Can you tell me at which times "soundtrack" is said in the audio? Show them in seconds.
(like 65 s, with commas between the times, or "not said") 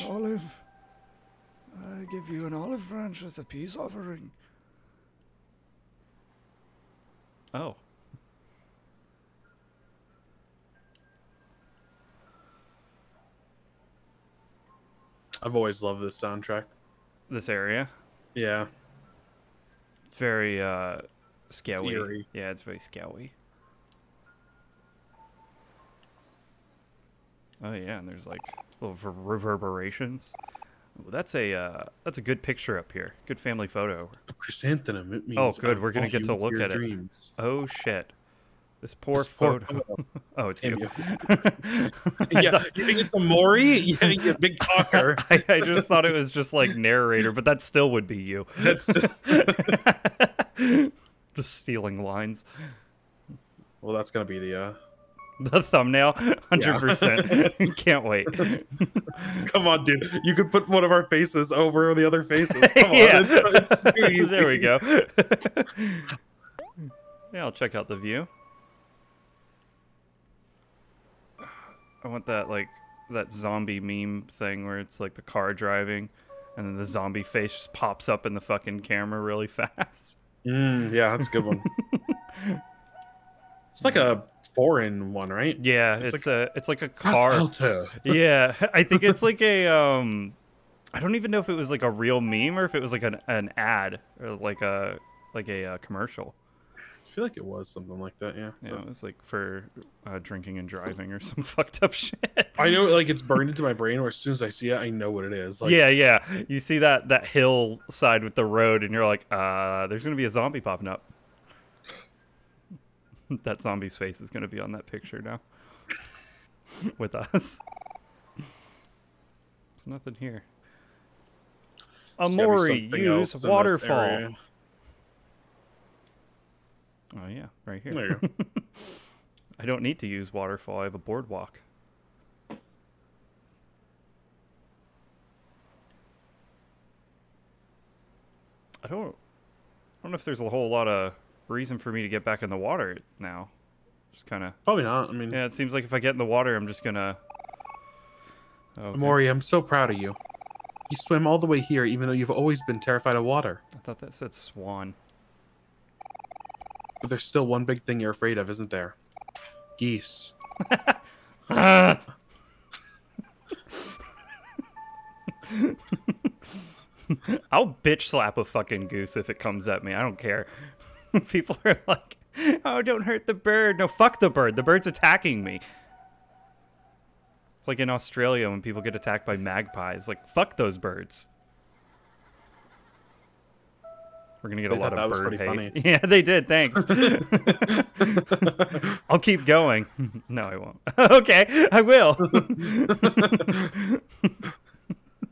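16 s.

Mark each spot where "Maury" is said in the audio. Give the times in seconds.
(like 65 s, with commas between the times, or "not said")
43 s.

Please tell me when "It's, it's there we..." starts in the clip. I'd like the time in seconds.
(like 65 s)
63 s.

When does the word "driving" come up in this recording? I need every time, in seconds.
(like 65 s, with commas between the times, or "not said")
75 s, 100 s.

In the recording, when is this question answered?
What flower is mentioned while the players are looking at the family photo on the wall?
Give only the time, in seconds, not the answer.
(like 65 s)
34 s.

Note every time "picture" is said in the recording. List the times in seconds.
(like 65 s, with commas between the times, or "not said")
32 s, 114 s.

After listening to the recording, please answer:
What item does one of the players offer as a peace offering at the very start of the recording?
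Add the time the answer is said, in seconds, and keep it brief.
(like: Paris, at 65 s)
An olive branch, at 2 s.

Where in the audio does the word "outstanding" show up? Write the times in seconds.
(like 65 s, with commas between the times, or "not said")
not said.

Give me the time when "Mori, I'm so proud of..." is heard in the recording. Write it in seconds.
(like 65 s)
148 s.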